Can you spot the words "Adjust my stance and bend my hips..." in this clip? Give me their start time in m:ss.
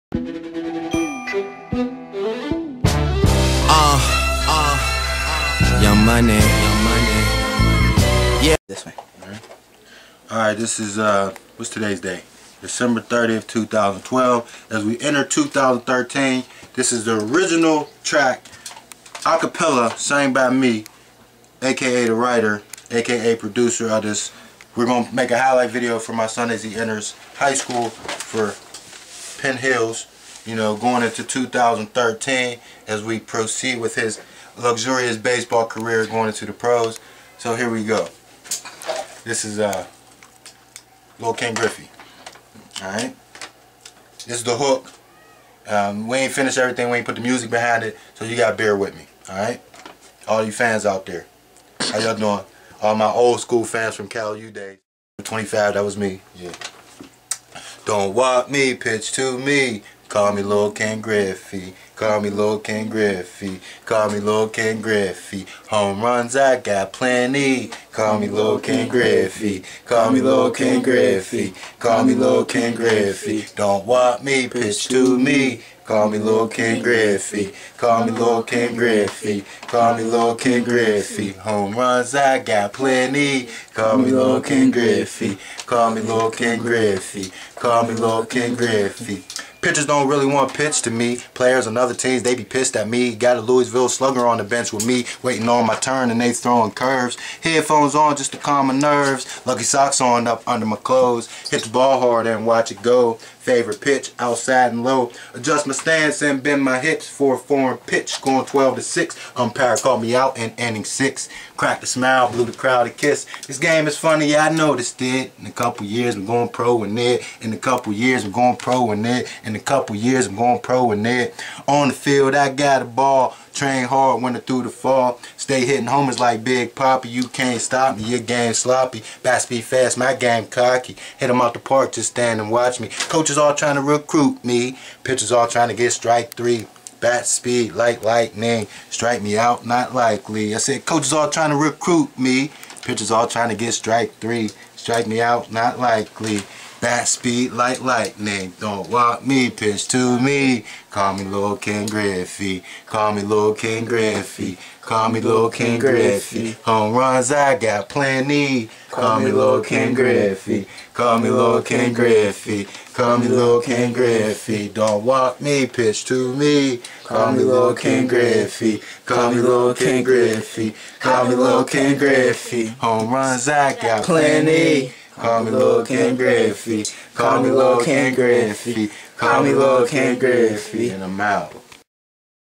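1:45.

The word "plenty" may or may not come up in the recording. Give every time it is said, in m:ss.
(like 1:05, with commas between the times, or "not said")
1:06, 1:22, 2:37, 2:54.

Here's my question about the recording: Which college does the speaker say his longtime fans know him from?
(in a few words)
Cal U.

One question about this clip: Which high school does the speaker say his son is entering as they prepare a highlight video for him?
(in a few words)
Penn Hills.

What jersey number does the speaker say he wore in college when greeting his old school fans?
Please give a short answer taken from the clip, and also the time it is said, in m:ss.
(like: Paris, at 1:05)
25, at 0:55.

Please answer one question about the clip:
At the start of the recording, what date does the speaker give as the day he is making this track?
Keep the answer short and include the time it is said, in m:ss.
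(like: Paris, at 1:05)
December 30th, 2012, at 0:12.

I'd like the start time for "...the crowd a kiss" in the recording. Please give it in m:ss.
1:52.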